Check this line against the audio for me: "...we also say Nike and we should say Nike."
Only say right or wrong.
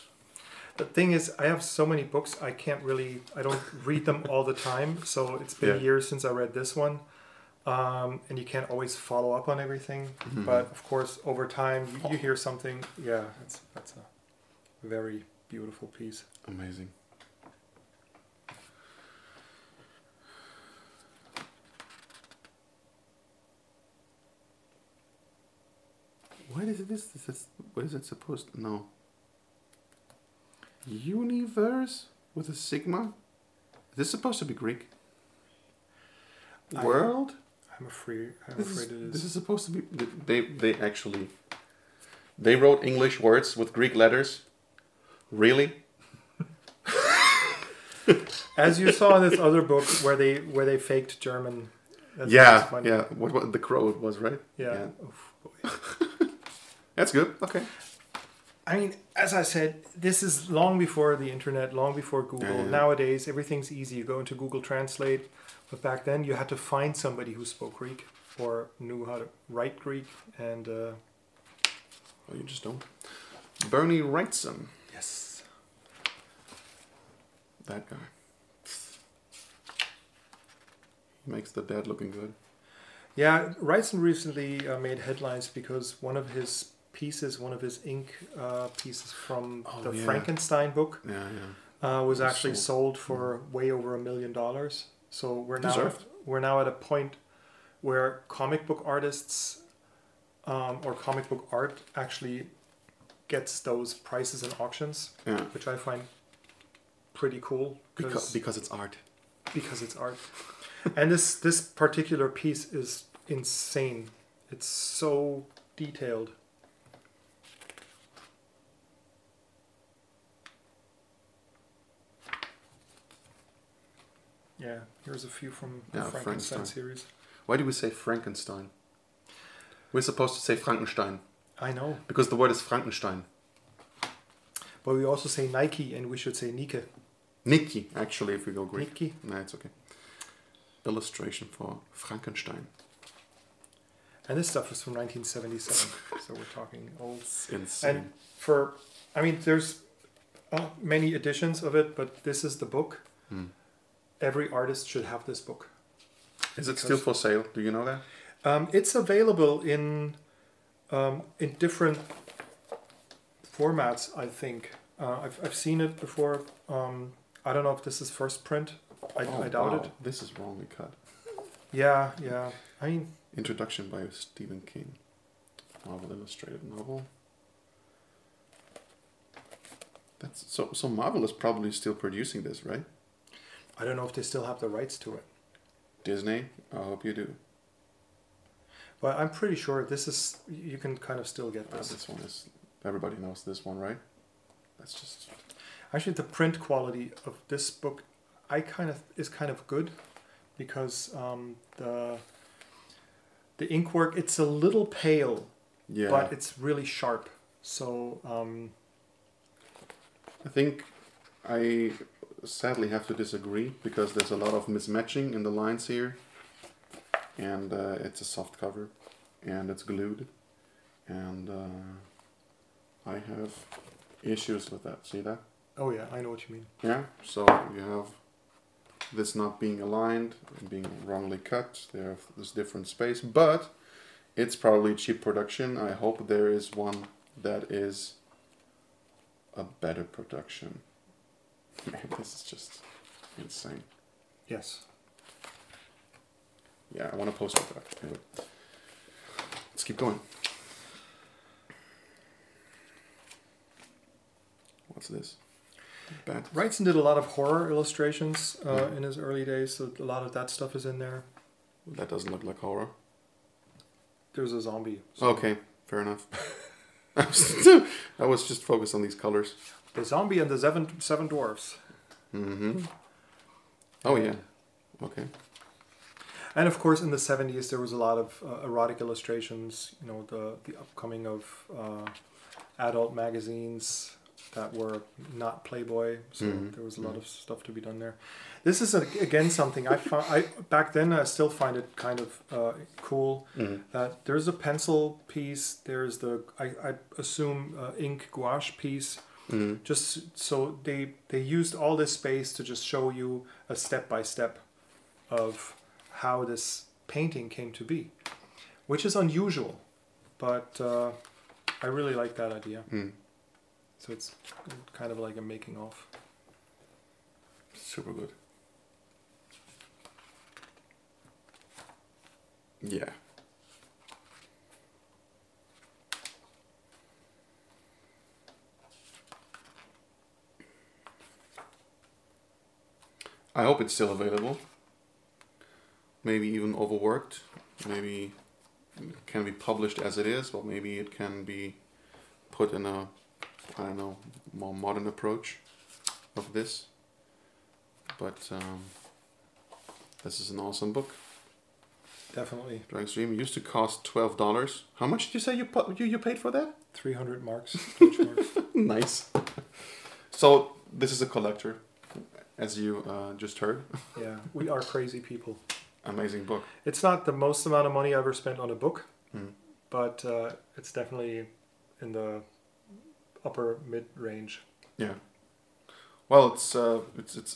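right.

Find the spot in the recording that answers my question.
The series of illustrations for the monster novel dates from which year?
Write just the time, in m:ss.
2:24.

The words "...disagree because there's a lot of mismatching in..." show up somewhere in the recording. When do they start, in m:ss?
3:33.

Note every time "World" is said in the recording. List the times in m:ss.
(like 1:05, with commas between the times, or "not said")
0:36.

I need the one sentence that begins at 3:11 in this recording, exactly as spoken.
Uh, this one is everybody knows this one, right?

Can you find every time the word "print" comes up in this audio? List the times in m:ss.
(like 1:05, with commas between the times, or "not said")
2:48, 3:16.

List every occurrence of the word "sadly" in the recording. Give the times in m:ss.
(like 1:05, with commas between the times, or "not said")
3:32.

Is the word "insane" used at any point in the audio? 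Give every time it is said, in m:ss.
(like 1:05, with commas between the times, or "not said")
1:53, 2:27, 4:03.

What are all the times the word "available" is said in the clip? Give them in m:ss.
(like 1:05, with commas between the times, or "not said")
2:38, 5:34.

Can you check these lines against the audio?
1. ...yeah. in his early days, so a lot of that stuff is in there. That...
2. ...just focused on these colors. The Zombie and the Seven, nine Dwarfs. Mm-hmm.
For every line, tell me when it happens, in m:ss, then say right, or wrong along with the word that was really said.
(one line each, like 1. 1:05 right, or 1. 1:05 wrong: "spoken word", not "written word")
1. 4:18 right
2. 4:28 wrong: "seven", not "nine".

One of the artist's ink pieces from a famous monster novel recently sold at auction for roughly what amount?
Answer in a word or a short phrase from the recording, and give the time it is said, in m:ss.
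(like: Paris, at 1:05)
over a million dollars, at 1:33.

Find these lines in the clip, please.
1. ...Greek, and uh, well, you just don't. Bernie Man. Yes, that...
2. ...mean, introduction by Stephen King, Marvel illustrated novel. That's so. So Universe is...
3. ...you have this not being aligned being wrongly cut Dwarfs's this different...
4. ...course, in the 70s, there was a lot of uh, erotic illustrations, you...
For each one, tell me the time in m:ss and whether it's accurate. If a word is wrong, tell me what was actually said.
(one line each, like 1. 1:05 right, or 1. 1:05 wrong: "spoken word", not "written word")
1. 1:09 wrong: "Wrightson", not "Man"
2. 2:52 wrong: "Marvel", not "Universe"
3. 3:47 wrong: "There", not "Dwarfs"
4. 4:36 right.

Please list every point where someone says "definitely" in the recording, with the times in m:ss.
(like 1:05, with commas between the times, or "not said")
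5:52, 6:10.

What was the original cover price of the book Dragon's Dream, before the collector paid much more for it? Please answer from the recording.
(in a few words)
$12.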